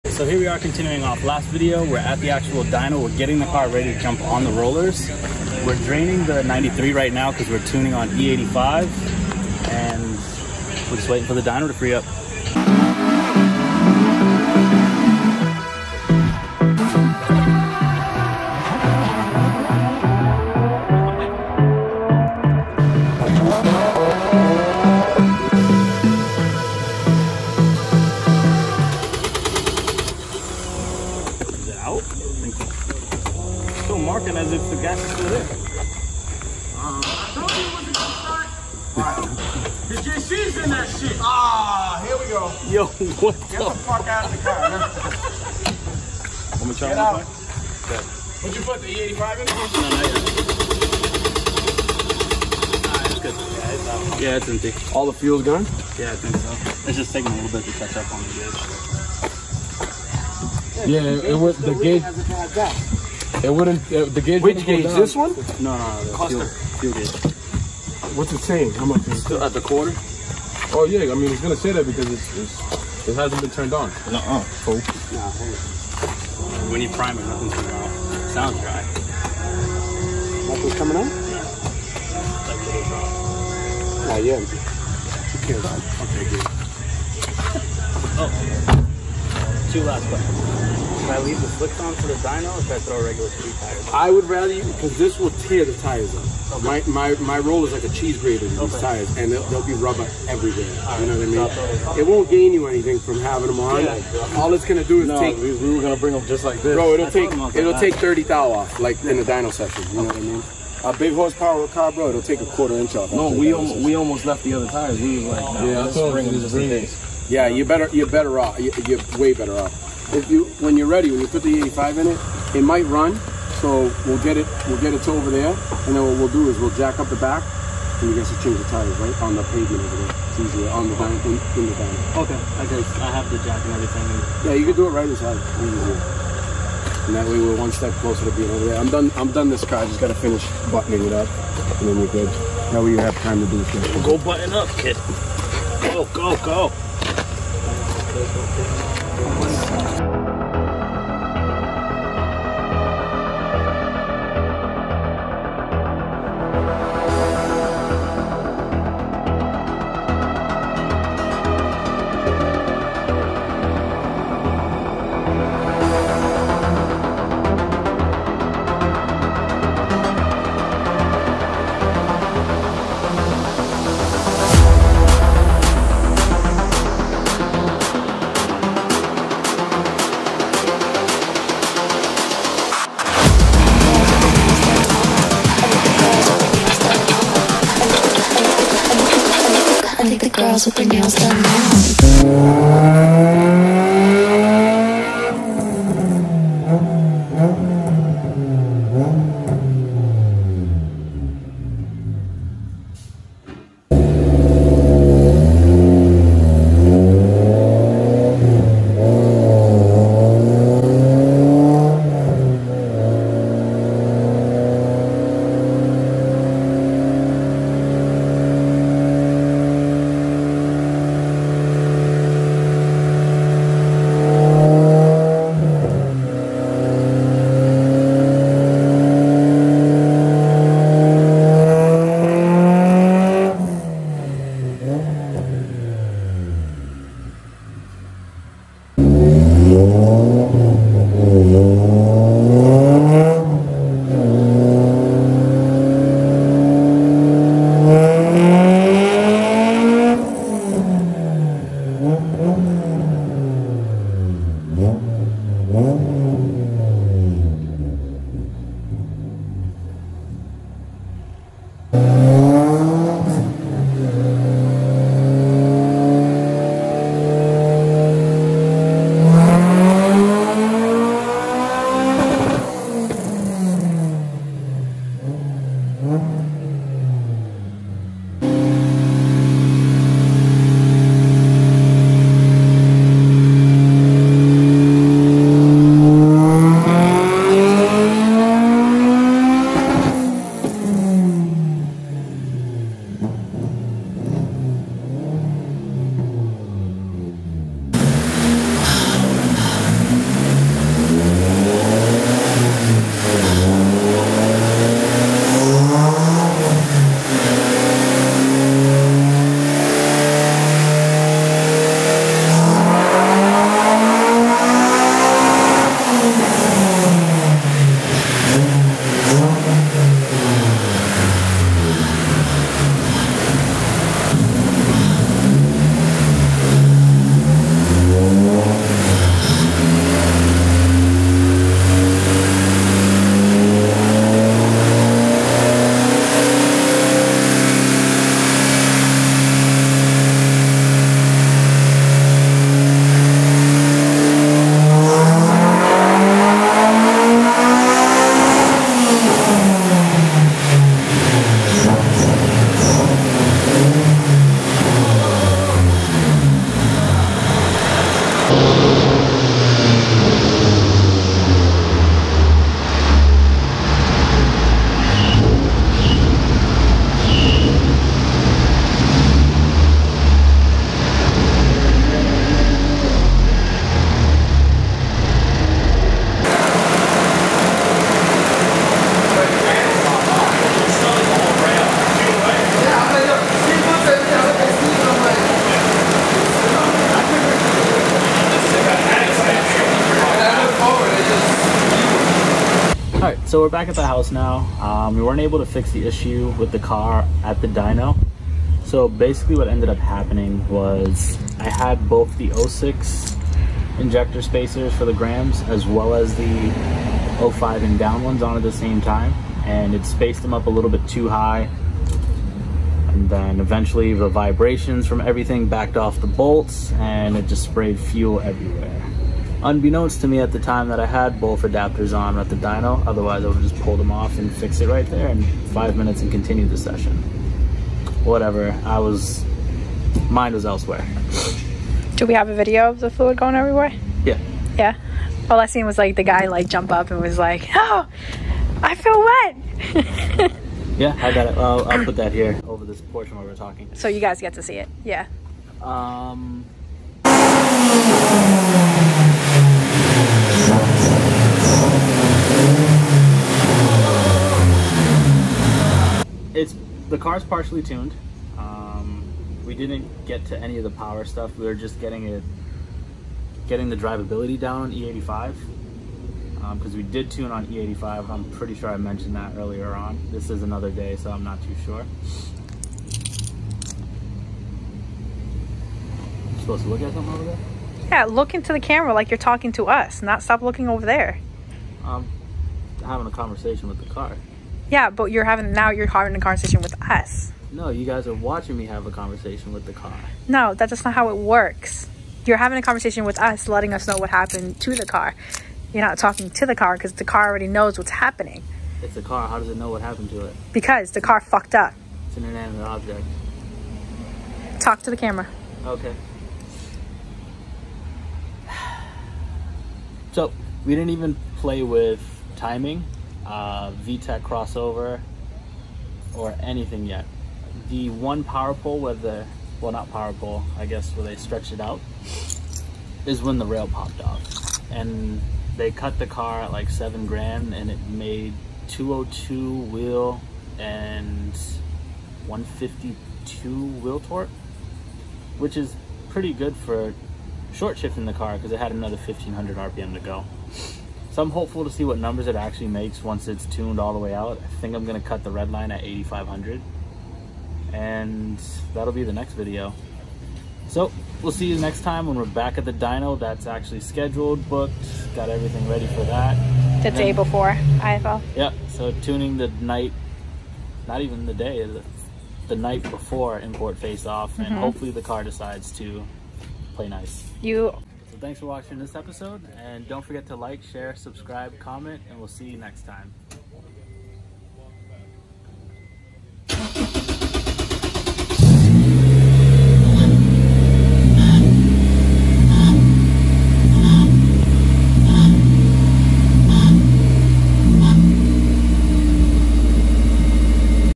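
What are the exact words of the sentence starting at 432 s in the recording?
Do we have a video of the fluid going everywhere?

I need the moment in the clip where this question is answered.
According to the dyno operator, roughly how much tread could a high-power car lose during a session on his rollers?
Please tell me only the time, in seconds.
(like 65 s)
112 s.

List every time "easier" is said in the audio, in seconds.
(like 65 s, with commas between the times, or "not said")
130 s, 135 s.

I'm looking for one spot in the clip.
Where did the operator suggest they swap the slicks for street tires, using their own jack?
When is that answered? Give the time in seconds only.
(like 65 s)
131 s.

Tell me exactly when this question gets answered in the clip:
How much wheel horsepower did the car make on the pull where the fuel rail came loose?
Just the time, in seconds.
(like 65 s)
528 s.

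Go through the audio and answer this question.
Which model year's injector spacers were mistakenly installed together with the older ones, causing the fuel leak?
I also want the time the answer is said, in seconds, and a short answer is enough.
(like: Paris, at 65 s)
06, at 402 s.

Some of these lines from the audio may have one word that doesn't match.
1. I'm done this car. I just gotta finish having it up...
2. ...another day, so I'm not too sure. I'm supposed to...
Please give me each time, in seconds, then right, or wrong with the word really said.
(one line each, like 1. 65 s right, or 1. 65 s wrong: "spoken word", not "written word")
1. 139 s wrong: "buttoning", not "having"
2. 470 s right.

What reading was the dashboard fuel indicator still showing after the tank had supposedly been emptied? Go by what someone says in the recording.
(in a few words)
a quarter.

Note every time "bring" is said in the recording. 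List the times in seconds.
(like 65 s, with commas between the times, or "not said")
105 s, 116 s.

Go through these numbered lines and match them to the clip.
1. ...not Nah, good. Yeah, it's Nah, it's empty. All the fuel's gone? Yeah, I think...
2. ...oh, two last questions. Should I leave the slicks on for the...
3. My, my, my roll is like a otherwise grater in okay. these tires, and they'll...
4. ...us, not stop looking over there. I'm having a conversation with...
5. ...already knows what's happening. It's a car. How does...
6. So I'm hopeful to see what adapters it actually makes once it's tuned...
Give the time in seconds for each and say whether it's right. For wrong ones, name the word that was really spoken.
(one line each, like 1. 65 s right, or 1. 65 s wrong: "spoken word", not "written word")
1. 52 s wrong: "Yeah", not "Nah"
2. 88 s right
3. 96 s wrong: "cheese", not "otherwise"
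4. 479 s right
5. 497 s right
6. 541 s wrong: "numbers", not "adapters".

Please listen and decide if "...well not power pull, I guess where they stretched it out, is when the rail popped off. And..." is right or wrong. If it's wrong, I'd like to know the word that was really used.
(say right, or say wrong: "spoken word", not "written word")
right.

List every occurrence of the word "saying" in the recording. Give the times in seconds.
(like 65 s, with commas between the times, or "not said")
68 s.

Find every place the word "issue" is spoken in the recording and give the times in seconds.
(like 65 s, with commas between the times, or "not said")
396 s.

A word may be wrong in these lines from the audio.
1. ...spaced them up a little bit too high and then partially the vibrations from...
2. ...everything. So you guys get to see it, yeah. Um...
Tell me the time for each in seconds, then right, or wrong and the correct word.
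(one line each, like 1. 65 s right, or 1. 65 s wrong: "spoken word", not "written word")
1. 410 s wrong: "eventually", not "partially"
2. 443 s wrong: "talking", not "everything".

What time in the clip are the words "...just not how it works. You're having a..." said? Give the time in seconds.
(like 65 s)
490 s.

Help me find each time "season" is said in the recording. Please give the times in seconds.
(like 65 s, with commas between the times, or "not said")
not said.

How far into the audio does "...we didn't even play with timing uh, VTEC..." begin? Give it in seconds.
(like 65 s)
510 s.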